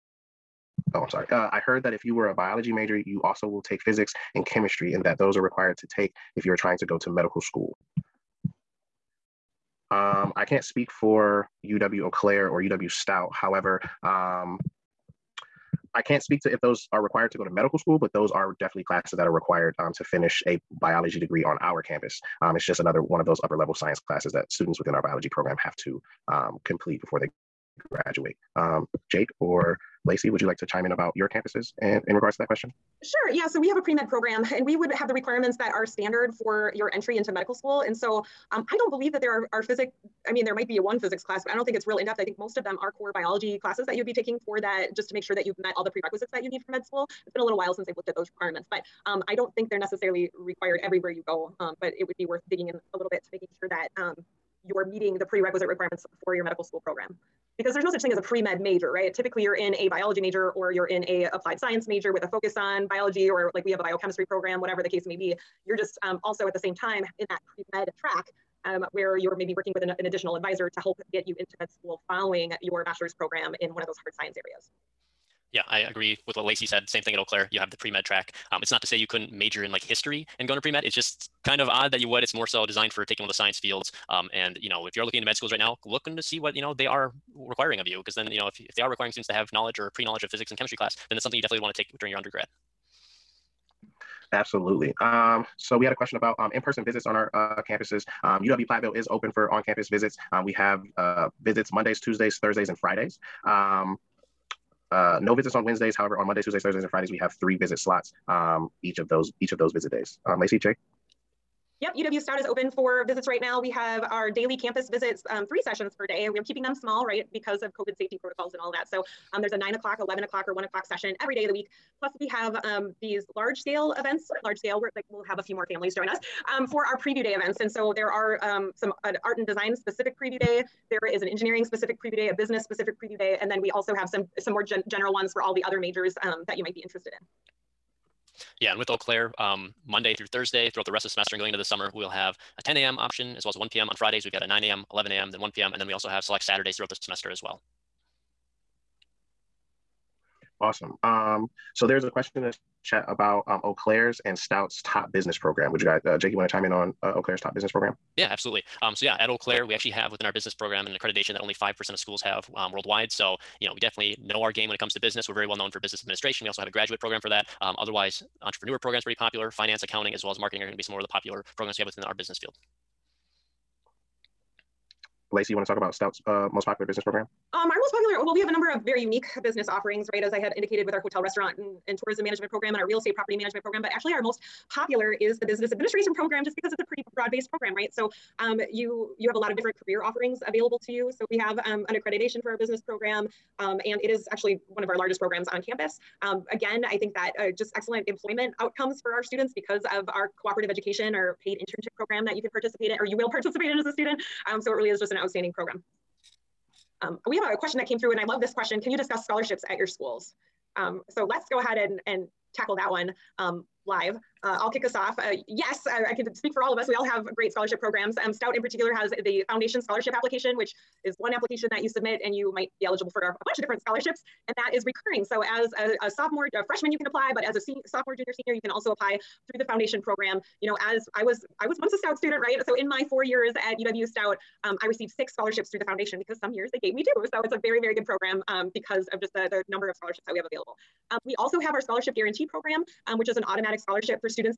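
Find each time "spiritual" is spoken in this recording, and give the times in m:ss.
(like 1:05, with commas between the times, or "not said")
not said.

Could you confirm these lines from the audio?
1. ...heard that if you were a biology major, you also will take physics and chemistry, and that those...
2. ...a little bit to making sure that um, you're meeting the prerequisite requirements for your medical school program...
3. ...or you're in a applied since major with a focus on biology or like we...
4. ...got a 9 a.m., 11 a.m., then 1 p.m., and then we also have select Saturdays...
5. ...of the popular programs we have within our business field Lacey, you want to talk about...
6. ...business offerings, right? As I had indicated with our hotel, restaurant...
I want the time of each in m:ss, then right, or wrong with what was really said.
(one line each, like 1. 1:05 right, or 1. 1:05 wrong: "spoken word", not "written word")
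1. 0:01 right
2. 0:52 right
3. 1:00 wrong: "science", not "since"
4. 2:24 right
5. 2:50 right
6. 2:59 right.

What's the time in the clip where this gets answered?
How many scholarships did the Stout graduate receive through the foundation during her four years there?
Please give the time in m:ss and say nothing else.
3:55.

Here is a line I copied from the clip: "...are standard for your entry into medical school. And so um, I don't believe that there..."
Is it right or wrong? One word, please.
right.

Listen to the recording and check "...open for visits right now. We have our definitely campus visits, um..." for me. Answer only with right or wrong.
wrong.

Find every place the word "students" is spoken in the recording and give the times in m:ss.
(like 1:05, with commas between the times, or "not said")
0:24, 1:29, 3:19, 3:23, 3:52.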